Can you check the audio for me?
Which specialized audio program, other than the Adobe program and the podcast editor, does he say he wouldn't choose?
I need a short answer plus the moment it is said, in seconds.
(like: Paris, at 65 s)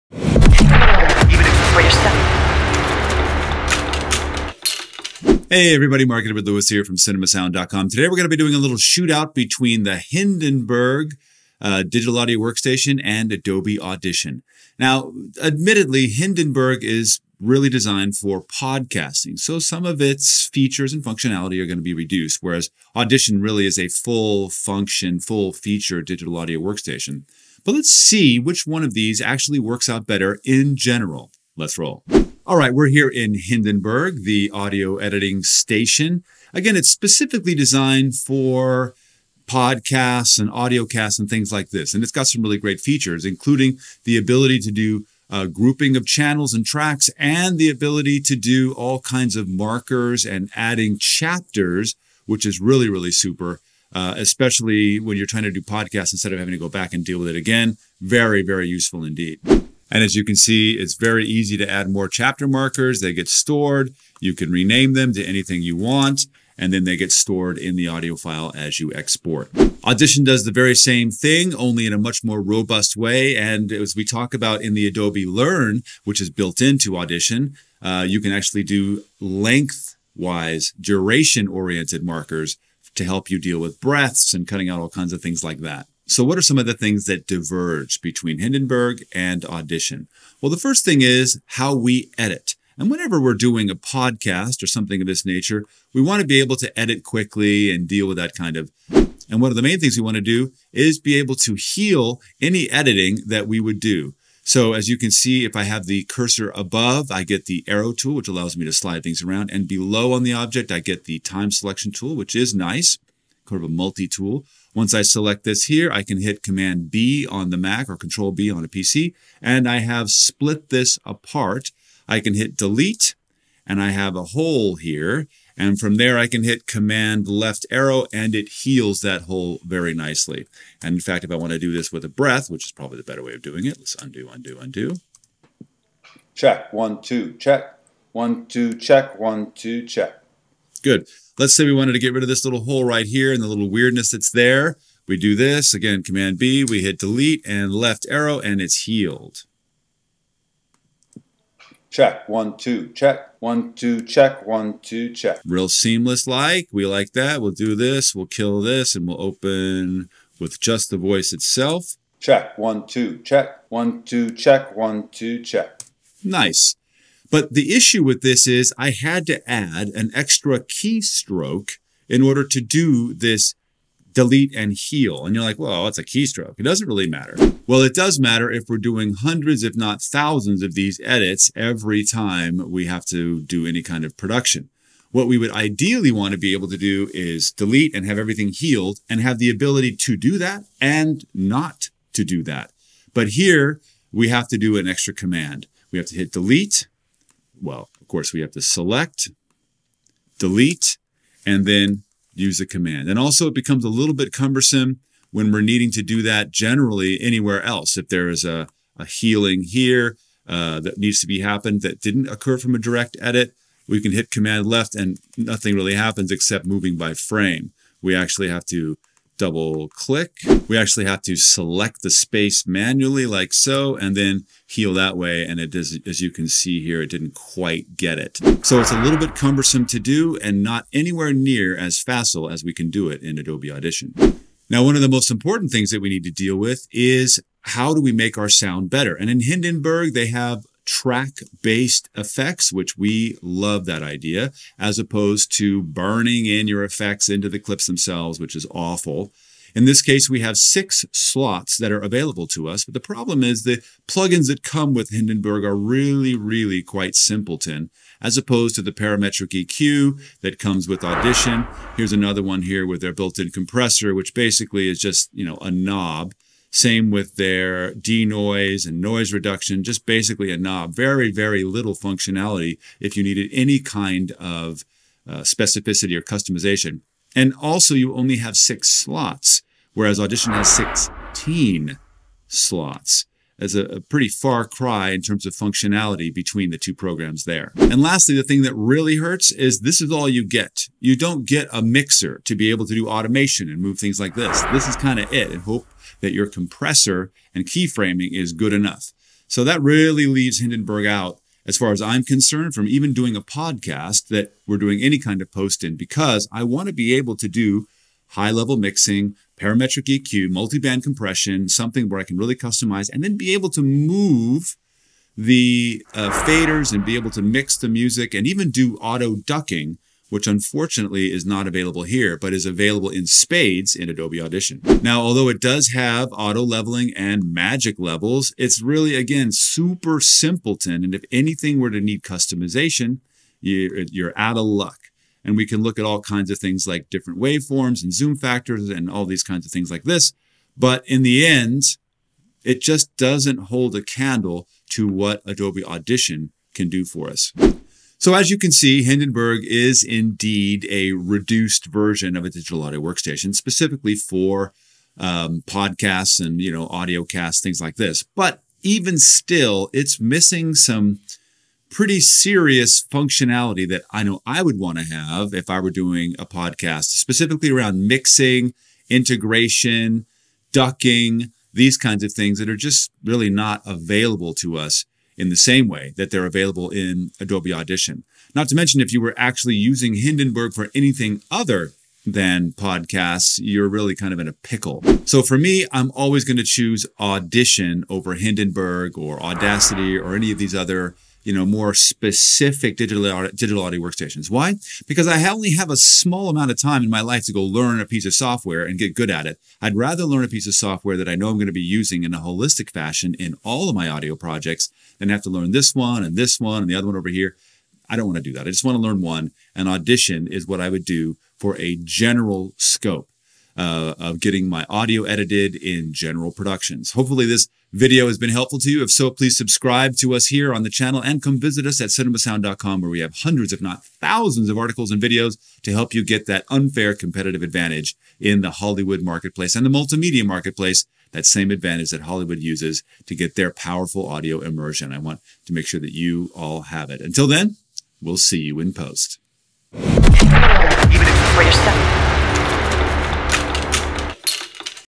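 Audacity, at 389 s.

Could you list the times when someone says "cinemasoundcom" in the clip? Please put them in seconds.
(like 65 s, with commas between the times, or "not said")
6 s, 422 s.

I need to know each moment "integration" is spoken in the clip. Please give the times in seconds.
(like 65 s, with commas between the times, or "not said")
369 s.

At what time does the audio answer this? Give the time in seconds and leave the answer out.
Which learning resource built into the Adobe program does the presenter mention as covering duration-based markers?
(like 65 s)
74 s.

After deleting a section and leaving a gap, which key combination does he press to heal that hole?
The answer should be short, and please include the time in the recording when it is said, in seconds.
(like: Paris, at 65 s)
Command left arrow, at 126 s.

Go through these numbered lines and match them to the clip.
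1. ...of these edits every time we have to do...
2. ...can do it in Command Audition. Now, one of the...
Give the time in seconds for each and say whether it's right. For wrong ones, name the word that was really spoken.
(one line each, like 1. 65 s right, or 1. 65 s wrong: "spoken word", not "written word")
1. 180 s right
2. 232 s wrong: "Adobe", not "Command".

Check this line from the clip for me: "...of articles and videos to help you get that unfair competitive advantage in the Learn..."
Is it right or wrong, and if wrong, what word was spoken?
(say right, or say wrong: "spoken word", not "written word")
wrong: "Hollywood", not "Learn".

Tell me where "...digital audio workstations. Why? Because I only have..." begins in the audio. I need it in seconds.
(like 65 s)
393 s.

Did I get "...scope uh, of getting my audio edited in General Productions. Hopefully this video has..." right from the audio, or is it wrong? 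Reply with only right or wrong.
right.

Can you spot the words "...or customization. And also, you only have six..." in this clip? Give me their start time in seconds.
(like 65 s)
276 s.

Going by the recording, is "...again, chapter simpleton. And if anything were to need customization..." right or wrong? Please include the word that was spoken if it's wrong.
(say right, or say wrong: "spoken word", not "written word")
wrong: "super", not "chapter".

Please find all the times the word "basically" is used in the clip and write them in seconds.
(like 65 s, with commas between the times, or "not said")
264 s, 270 s.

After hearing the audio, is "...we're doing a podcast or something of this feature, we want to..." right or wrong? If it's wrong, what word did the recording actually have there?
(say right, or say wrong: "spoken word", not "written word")
wrong: "nature", not "feature".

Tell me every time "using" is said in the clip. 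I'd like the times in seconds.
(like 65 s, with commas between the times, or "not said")
379 s, 401 s.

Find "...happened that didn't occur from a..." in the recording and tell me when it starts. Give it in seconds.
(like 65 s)
211 s.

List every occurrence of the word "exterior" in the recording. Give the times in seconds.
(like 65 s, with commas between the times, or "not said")
not said.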